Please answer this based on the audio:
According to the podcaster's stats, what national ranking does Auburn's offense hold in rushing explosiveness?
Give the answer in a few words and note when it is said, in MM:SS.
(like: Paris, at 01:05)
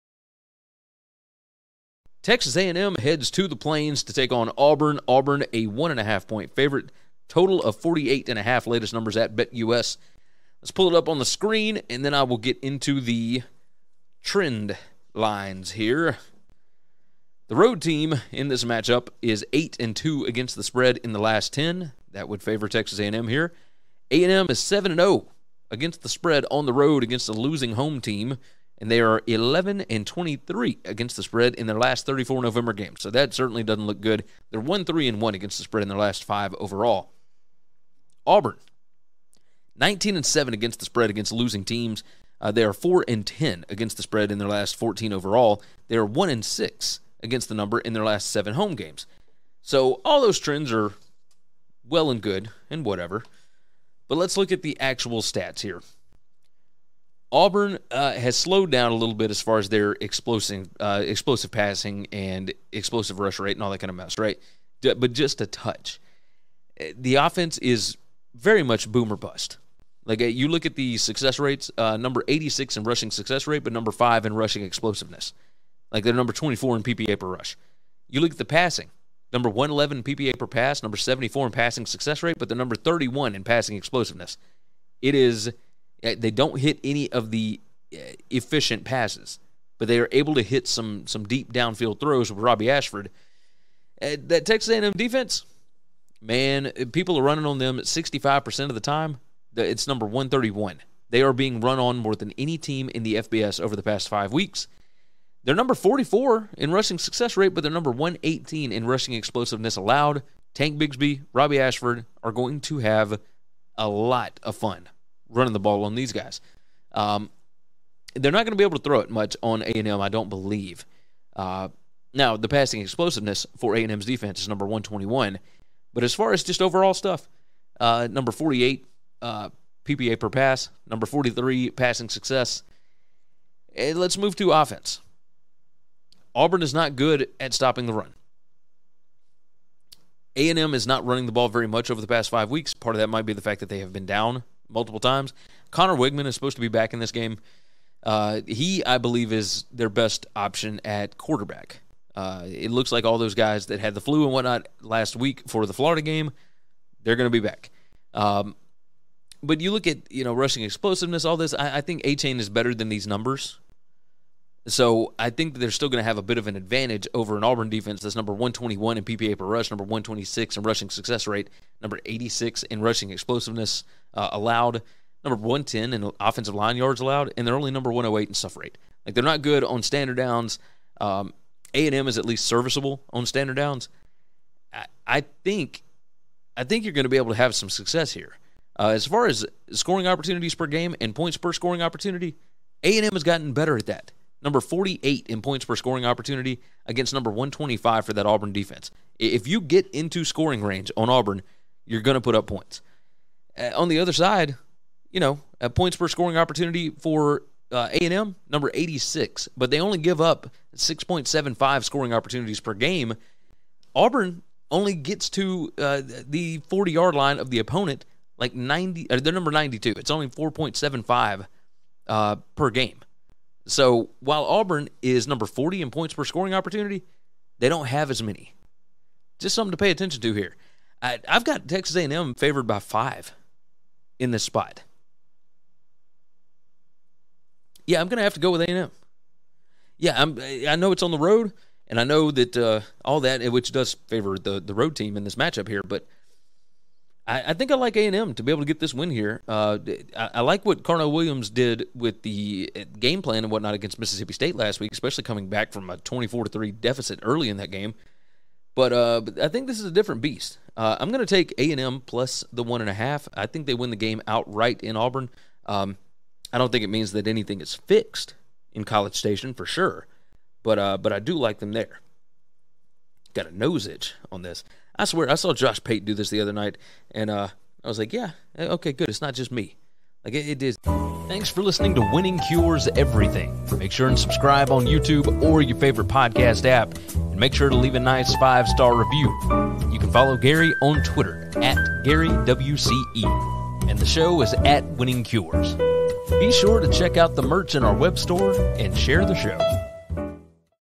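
5, at 01:13.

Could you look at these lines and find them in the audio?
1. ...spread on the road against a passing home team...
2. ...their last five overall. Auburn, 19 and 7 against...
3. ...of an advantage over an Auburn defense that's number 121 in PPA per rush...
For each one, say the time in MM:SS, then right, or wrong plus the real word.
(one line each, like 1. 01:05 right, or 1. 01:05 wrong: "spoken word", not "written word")
1. 00:26 wrong: "losing", not "passing"
2. 00:35 right
3. 02:46 right.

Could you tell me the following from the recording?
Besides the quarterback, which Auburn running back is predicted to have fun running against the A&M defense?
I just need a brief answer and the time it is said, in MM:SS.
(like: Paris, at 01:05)
Tank Bigsby, at 01:50.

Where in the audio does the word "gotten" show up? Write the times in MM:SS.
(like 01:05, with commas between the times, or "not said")
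03:13.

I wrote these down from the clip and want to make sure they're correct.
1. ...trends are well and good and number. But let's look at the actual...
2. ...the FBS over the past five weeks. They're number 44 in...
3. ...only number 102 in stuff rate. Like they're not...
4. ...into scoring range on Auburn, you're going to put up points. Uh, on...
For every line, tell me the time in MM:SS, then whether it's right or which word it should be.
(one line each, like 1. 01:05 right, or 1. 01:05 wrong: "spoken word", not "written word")
1. 00:50 wrong: "whatever", not "number"
2. 01:43 right
3. 02:57 wrong: "108", not "102"
4. 03:19 right.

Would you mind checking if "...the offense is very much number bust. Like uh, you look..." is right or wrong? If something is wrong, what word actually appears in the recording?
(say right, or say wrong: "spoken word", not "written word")
wrong: "boomer", not "number".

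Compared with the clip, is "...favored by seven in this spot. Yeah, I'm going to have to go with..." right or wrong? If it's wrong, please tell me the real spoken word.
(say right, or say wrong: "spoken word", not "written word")
wrong: "five", not "seven".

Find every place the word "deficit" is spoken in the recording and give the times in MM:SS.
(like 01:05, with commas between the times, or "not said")
04:16.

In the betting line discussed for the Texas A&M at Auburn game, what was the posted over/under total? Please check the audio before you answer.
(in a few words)
48.5.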